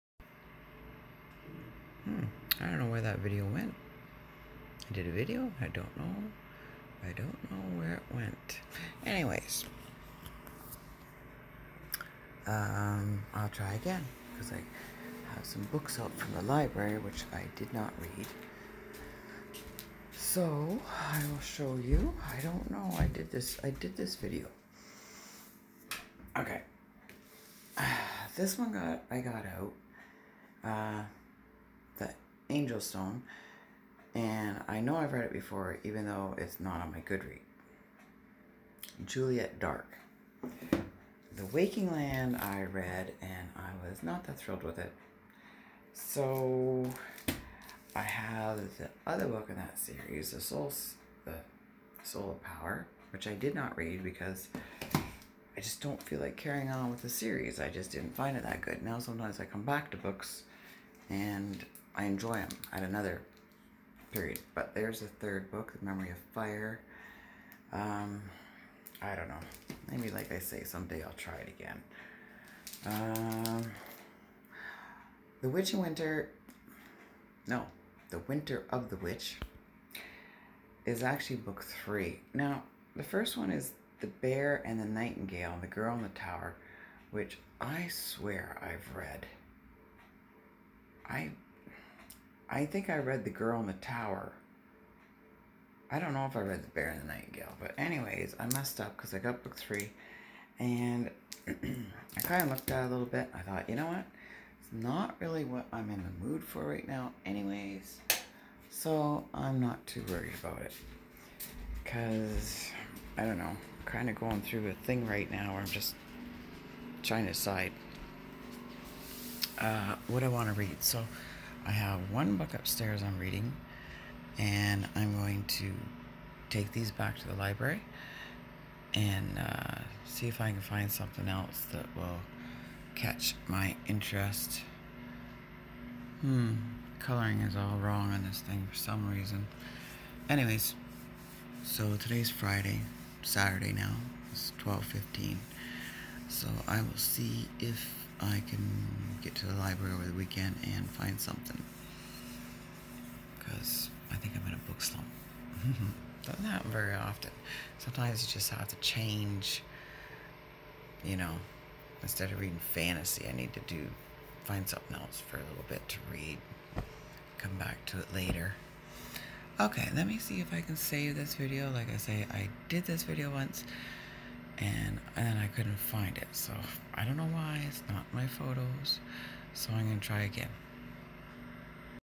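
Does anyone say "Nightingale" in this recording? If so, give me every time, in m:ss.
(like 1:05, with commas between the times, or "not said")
1:24, 1:37.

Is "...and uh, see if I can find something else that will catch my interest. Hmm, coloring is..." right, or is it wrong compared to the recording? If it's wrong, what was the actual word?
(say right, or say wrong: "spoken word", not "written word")
right.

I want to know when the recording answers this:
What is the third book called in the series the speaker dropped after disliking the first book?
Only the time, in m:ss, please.
1:05.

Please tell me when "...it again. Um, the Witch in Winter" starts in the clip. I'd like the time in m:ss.
1:11.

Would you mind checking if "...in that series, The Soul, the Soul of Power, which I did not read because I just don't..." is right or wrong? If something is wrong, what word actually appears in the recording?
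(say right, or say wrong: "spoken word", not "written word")
right.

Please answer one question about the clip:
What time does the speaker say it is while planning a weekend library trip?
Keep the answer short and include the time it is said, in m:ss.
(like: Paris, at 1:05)
12:15, at 2:24.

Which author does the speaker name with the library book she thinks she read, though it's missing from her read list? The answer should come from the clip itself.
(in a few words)
Juliet Dark.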